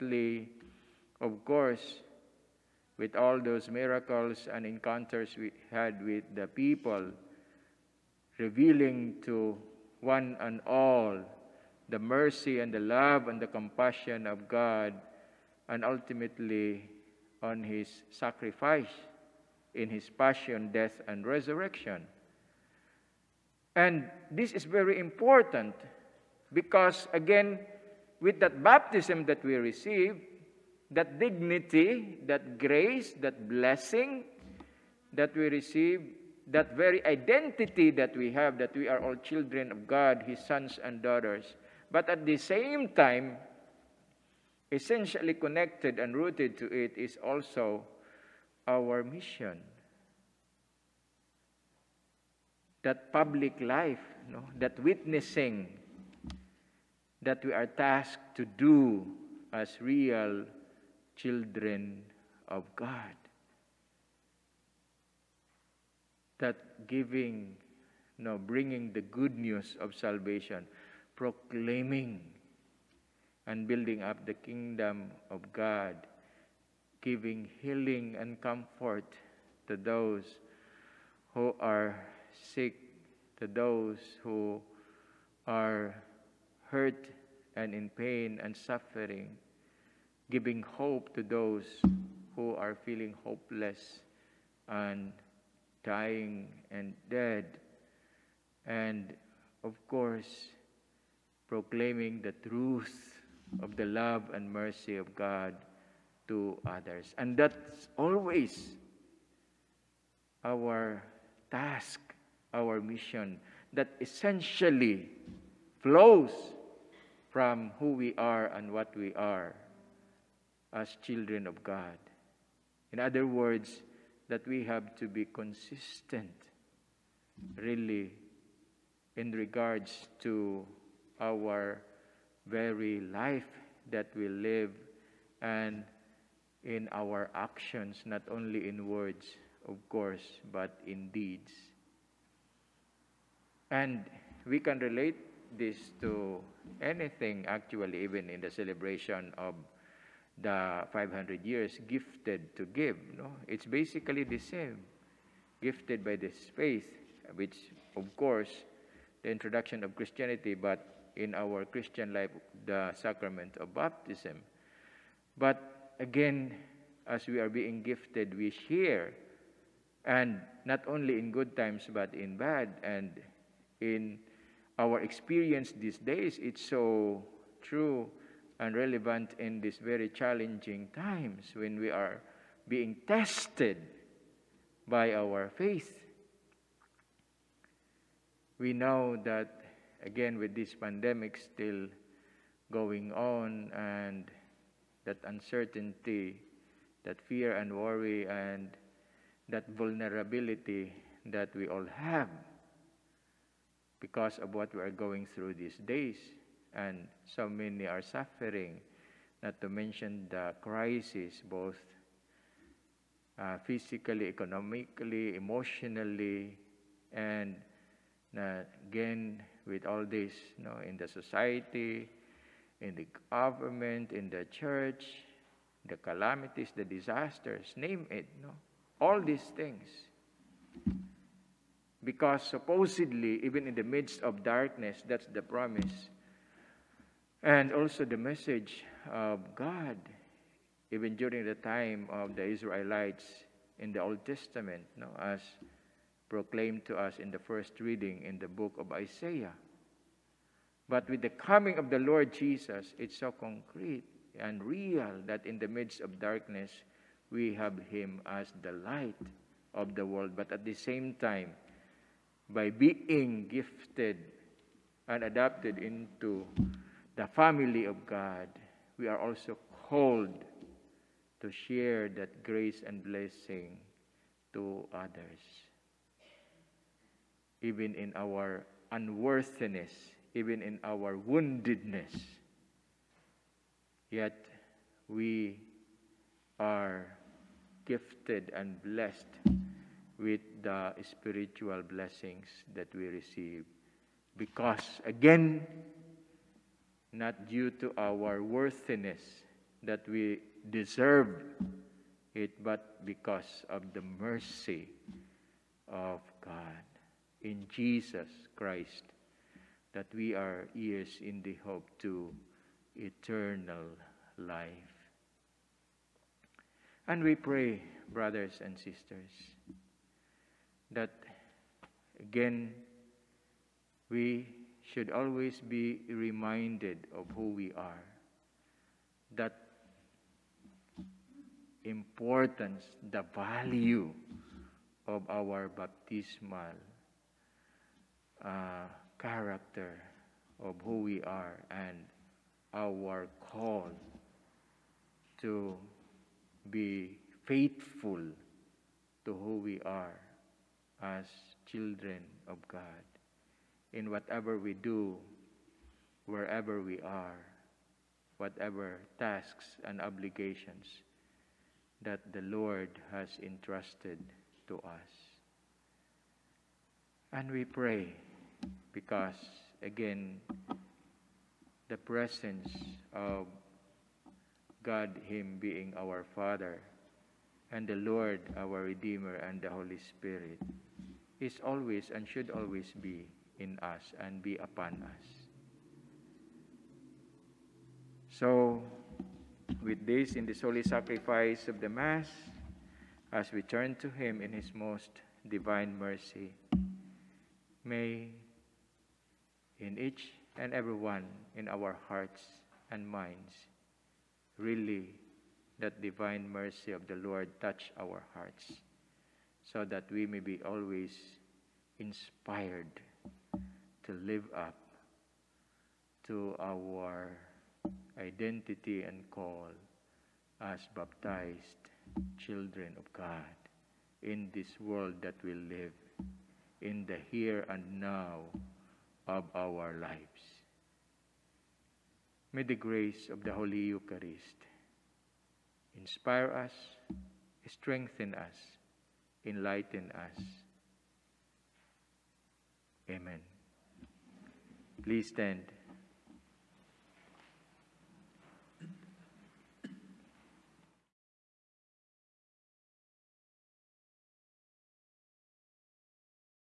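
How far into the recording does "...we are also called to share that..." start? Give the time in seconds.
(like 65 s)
268 s.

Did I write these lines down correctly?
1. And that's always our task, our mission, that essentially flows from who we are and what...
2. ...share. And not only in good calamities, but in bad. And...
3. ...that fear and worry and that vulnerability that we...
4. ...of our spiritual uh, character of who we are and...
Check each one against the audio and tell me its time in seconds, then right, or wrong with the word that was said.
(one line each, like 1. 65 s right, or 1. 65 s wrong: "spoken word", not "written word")
1. 107 s right
2. 168 s wrong: "times", not "calamities"
3. 197 s right
4. 335 s wrong: "baptismal", not "spiritual".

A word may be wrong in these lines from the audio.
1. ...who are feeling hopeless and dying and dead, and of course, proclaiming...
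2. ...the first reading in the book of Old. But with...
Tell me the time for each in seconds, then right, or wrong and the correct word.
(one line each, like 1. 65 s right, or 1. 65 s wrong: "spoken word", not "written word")
1. 92 s right
2. 247 s wrong: "Isaiah", not "Old".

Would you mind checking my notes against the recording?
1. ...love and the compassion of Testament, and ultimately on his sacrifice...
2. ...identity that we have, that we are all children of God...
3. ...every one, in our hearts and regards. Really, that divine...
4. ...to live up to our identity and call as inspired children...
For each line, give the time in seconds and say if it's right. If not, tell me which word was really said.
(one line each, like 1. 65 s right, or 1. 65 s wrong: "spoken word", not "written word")
1. 12 s wrong: "God", not "Testament"
2. 37 s right
3. 400 s wrong: "minds", not "regards"
4. 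414 s wrong: "baptized", not "inspired".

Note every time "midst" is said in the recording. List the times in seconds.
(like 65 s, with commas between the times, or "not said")
233 s, 255 s.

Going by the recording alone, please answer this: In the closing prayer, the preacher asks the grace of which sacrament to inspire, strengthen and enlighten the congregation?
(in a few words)
Holy Eucharist.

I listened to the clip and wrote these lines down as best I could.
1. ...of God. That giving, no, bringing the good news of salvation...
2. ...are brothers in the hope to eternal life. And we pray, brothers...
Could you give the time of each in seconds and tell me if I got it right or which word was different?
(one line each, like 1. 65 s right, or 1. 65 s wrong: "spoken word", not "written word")
1. 62 s right
2. 310 s wrong: "heirs", not "brothers".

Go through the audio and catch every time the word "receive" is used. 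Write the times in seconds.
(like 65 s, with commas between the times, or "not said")
29 s, 35 s, 293 s.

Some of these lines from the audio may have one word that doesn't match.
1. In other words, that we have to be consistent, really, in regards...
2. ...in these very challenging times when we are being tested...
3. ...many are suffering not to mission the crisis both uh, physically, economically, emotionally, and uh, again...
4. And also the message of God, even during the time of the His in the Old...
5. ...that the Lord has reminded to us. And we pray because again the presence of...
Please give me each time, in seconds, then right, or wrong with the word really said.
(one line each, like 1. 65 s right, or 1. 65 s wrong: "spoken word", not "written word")
1. 122 s right
2. 179 s right
3. 207 s wrong: "mention", not "mission"
4. 237 s wrong: "Israelites", not "His"
5. 362 s wrong: "entrusted", not "reminded".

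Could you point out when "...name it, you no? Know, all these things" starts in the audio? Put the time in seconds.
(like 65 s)
227 s.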